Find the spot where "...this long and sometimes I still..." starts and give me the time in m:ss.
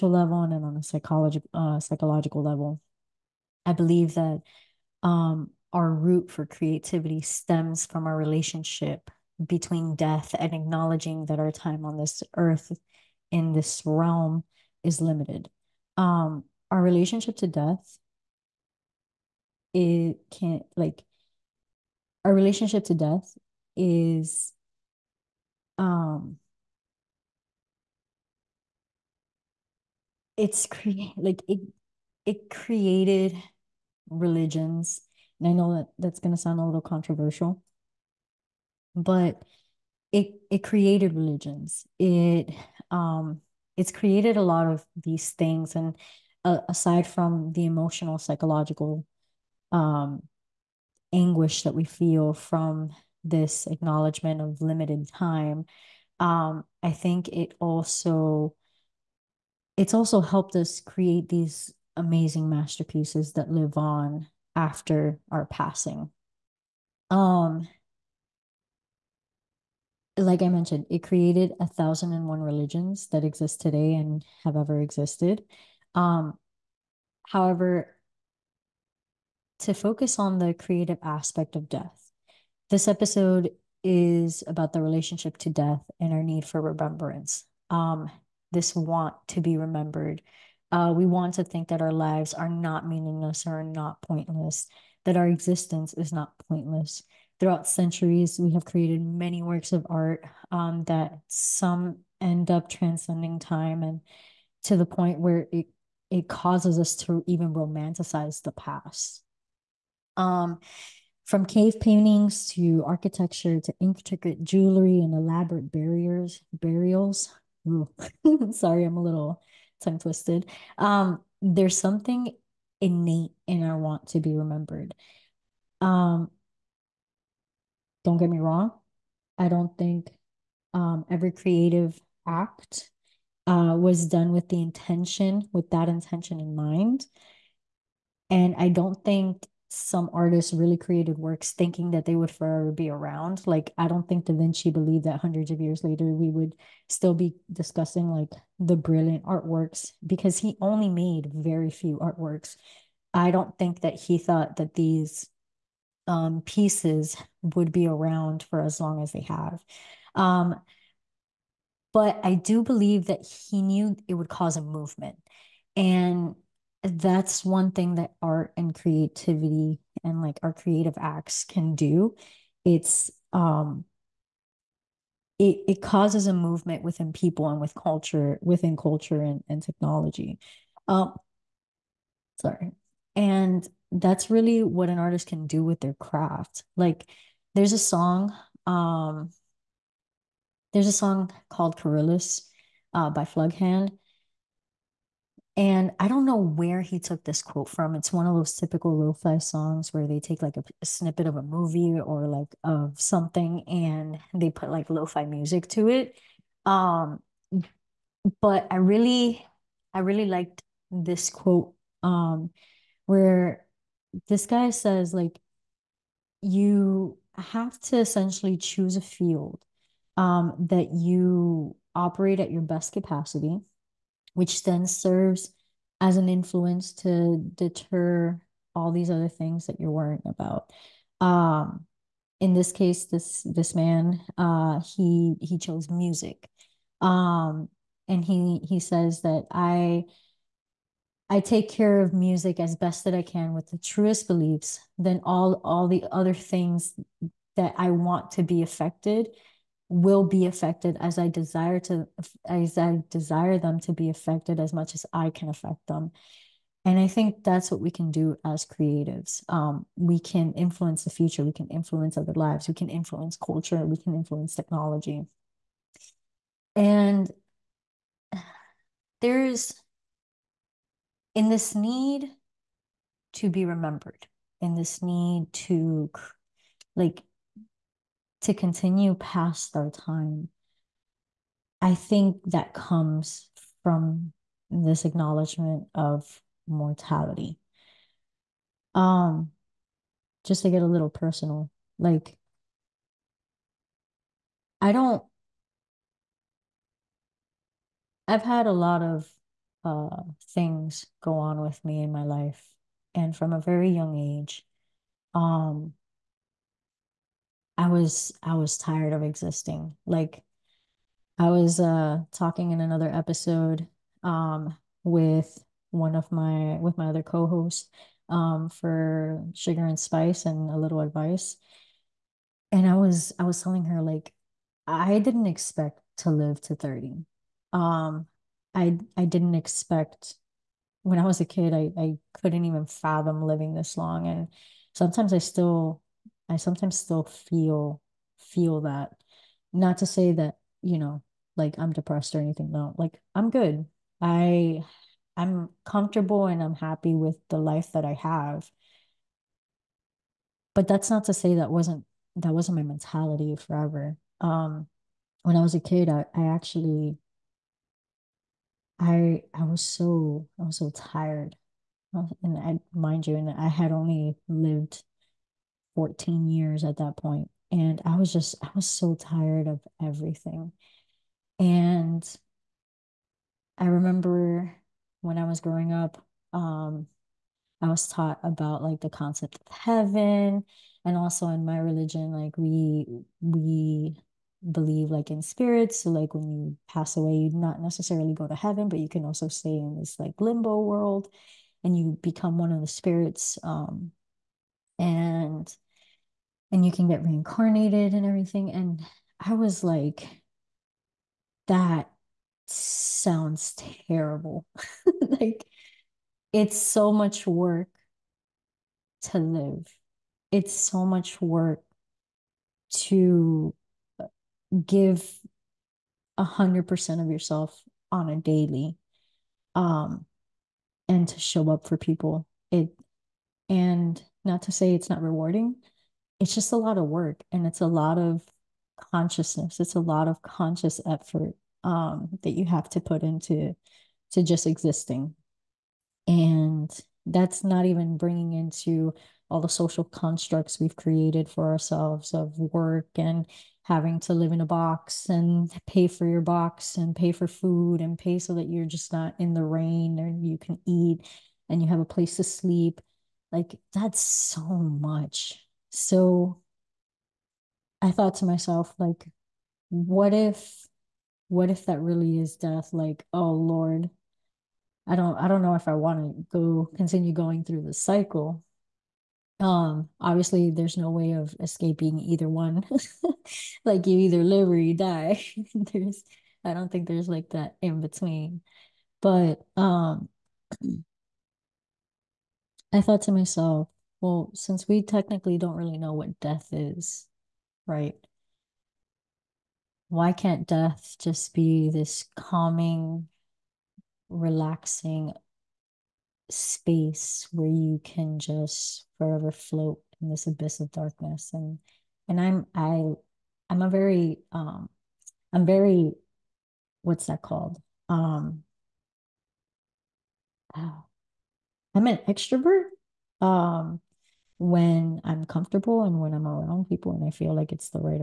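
5:33.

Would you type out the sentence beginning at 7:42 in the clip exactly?
Like, oh Lord, I don't, I don't know if I want to go continue going through the cycle.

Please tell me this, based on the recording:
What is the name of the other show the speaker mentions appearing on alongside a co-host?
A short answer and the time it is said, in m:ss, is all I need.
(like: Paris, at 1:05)
Sugar and Spice and a Little Advice, at 5:19.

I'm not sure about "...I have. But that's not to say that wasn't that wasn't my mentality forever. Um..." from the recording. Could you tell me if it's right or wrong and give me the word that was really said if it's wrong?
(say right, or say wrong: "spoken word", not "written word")
right.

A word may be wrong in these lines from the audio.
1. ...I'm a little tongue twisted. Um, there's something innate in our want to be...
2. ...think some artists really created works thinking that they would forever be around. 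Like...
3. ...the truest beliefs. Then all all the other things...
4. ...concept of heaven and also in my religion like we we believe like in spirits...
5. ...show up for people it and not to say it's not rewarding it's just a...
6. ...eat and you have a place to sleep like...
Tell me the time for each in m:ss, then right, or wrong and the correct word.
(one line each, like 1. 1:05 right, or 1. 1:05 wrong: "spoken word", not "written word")
1. 1:58 right
2. 2:19 right
3. 4:03 right
4. 6:19 right
5. 7:01 right
6. 7:30 right.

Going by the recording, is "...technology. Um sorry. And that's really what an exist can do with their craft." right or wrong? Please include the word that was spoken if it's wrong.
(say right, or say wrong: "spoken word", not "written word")
wrong: "artist", not "exist".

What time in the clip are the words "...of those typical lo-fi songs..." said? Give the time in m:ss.
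3:18.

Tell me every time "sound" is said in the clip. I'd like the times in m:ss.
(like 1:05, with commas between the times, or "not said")
0:36, 6:42.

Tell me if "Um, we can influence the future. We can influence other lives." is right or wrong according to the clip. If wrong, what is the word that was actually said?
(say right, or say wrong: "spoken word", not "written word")
right.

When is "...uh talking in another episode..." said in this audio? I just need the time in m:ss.
5:11.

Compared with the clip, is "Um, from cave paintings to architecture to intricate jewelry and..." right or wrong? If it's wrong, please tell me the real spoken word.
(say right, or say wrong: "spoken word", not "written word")
right.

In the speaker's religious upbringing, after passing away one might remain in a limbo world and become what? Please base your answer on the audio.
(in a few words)
One of the spirits.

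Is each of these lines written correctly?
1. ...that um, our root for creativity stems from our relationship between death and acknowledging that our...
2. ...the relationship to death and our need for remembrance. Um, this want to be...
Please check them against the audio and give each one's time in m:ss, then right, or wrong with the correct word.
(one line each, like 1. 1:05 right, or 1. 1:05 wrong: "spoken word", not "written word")
1. 0:04 right
2. 1:24 right.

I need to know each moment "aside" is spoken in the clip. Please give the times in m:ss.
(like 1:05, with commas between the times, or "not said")
0:46.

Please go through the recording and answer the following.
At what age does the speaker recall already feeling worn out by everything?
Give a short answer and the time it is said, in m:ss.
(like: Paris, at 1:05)
14, at 6:05.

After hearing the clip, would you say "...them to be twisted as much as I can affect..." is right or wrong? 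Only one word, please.
wrong.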